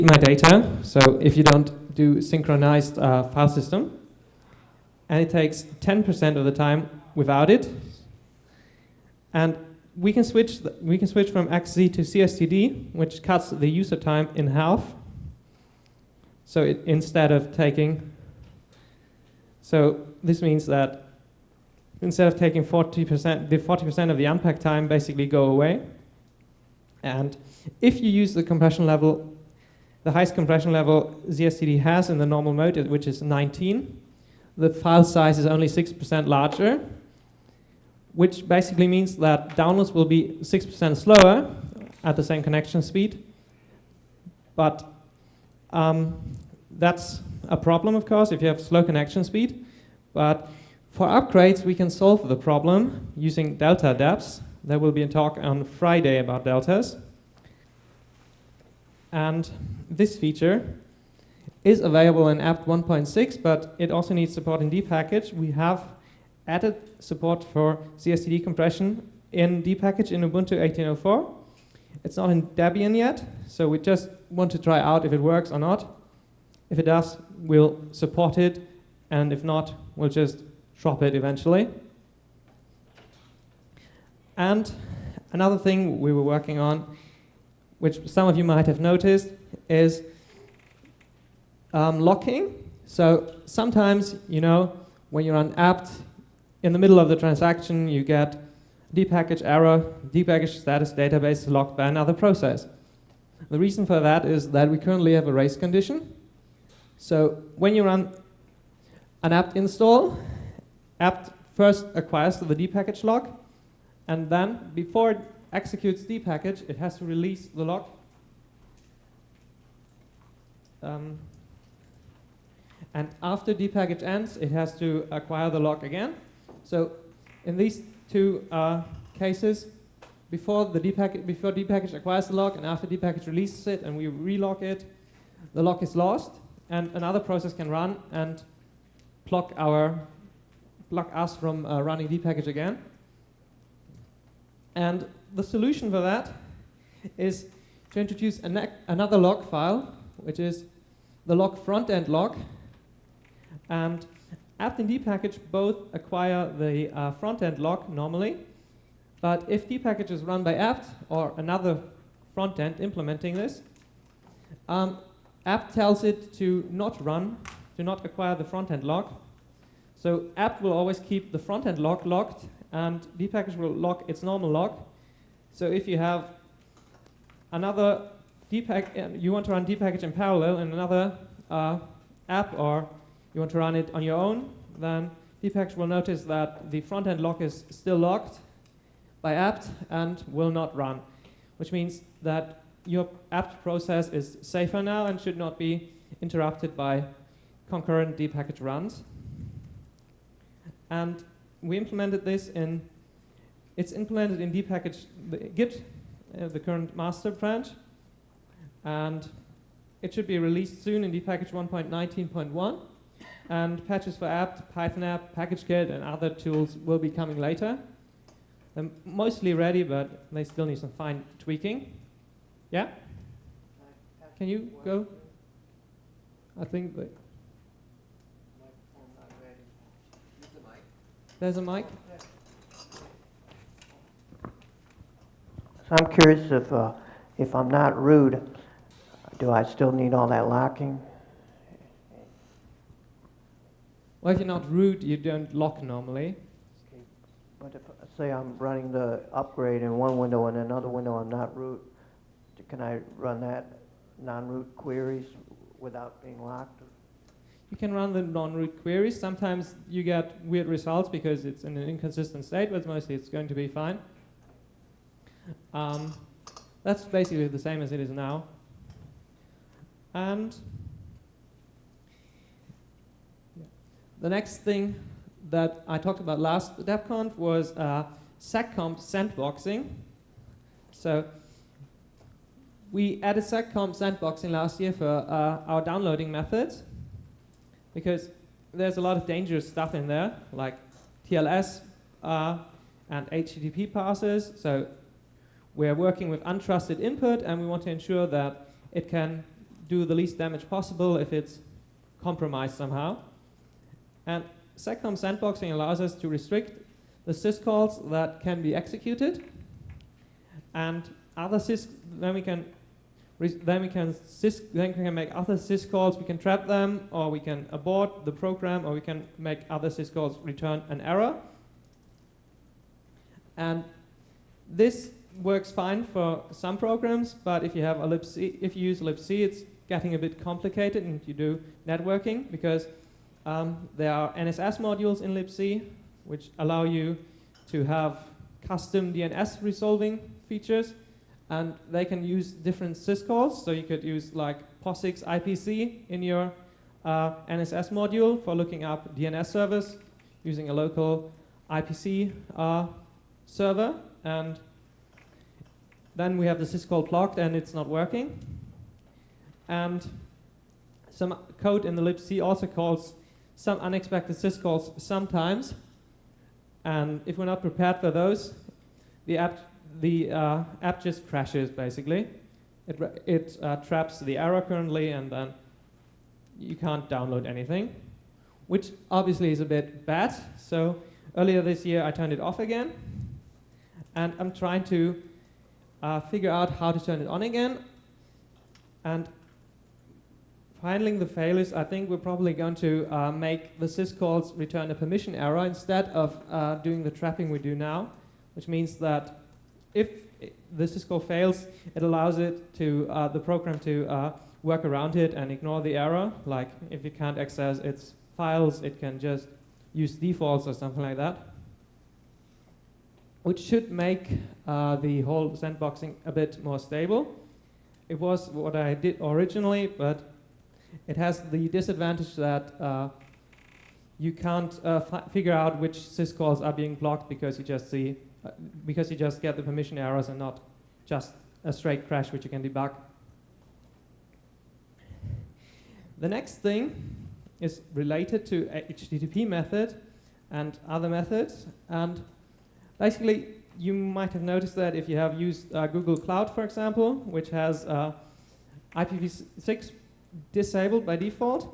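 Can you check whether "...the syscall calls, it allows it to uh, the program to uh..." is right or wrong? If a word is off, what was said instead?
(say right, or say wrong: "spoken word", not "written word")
wrong: "fails", not "calls".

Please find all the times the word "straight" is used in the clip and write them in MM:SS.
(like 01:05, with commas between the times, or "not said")
07:11.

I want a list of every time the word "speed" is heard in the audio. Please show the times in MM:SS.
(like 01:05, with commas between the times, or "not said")
00:42, 00:49.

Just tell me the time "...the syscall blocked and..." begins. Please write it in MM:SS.
05:56.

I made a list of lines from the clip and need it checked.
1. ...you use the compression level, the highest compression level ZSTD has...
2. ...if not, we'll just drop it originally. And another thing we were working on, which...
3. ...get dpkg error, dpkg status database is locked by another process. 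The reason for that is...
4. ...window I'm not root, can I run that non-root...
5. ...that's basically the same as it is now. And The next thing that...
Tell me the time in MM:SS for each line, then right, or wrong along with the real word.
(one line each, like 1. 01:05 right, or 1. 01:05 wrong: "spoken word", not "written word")
1. 00:27 right
2. 01:19 wrong: "eventually", not "originally"
3. 01:38 right
4. 04:10 right
5. 04:26 right.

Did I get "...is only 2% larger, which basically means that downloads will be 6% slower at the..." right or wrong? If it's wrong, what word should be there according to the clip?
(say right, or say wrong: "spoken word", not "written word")
wrong: "6", not "2".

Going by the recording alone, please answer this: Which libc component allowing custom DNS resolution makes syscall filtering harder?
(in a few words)
NSS modules.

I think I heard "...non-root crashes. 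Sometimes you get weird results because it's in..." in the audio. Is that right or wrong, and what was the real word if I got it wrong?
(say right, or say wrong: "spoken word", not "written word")
wrong: "queries", not "crashes".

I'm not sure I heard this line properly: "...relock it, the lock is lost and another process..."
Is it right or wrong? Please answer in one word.
right.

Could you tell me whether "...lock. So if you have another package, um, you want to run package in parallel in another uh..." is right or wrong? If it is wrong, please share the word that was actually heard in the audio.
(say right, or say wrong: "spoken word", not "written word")
right.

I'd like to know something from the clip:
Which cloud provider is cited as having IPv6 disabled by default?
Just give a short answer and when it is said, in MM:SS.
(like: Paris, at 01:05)
Google Cloud, at 07:25.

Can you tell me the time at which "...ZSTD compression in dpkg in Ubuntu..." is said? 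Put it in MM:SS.
01:07.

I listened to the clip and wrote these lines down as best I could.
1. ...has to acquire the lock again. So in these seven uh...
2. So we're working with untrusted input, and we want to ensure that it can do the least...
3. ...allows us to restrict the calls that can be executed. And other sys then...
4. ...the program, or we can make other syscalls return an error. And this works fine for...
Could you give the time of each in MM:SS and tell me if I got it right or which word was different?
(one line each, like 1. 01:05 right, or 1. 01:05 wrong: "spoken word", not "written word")
1. 02:04 wrong: "two", not "seven"
2. 04:54 right
3. 05:05 wrong: "syscalls", not "calls"
4. 05:18 right.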